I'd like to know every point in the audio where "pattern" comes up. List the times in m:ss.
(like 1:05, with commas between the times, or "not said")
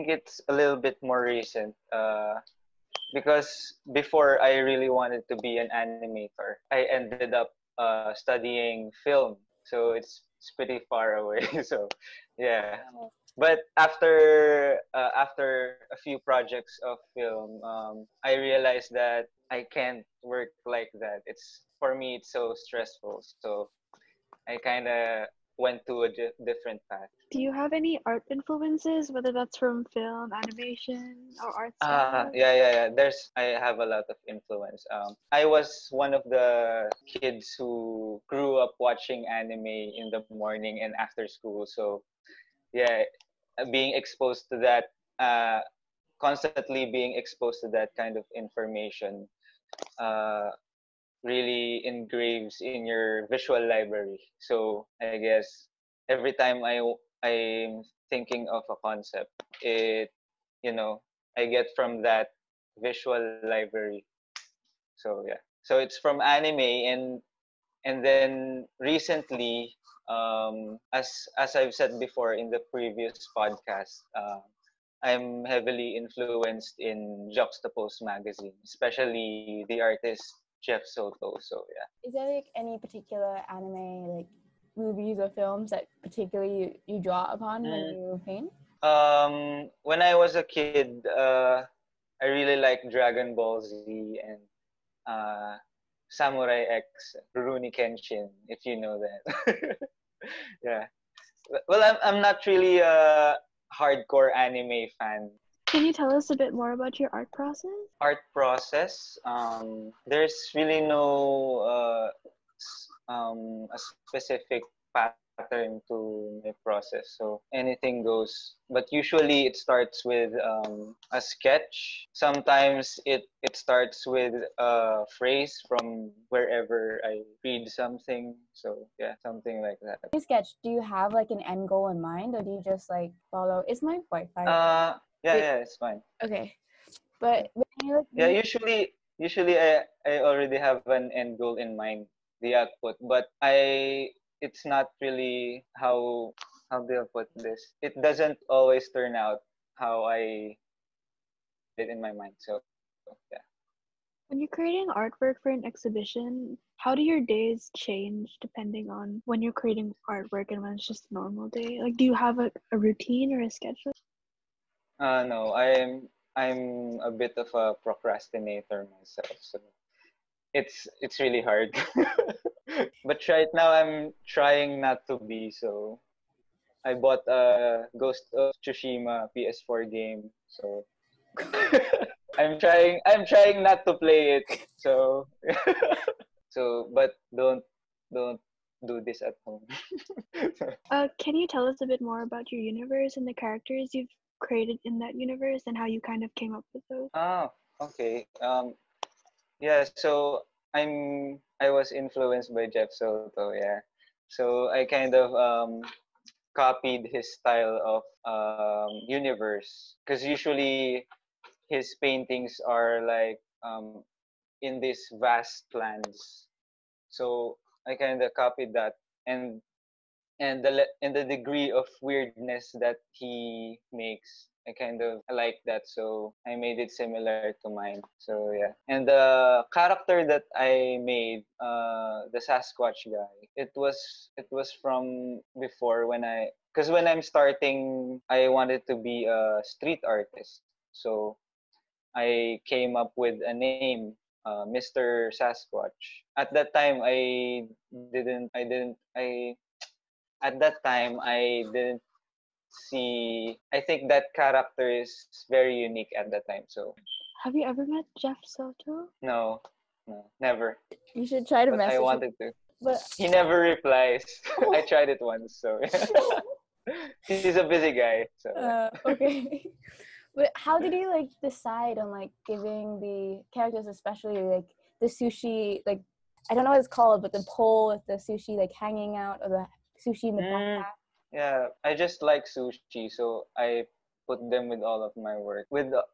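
1:54.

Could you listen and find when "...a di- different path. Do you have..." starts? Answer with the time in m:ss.
0:26.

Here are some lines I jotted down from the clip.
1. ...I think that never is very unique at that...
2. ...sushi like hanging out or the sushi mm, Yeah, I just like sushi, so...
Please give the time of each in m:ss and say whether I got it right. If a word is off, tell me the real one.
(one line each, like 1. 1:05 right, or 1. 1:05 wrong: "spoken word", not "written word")
1. 4:13 wrong: "character", not "never"
2. 4:38 right.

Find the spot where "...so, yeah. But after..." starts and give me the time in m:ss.
0:11.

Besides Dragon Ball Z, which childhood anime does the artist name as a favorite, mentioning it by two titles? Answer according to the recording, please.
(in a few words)
Samurai X (Rurouni Kenshin).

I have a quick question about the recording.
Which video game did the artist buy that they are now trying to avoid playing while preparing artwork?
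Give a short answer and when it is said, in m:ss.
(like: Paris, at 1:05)
Ghost of Tsushima, at 2:57.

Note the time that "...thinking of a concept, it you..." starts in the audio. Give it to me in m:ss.
0:58.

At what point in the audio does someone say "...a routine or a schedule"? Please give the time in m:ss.
2:42.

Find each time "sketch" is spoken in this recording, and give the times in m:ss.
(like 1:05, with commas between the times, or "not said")
2:01, 2:10.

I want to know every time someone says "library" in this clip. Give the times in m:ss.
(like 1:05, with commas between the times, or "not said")
0:53, 1:03.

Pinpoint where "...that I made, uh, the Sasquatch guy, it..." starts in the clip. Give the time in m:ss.
3:50.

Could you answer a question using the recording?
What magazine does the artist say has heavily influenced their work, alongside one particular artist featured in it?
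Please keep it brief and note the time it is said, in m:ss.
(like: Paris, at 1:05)
Juxtapose, at 1:17.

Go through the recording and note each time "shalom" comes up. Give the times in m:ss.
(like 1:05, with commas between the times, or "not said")
not said.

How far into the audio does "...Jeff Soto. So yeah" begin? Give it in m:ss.
1:20.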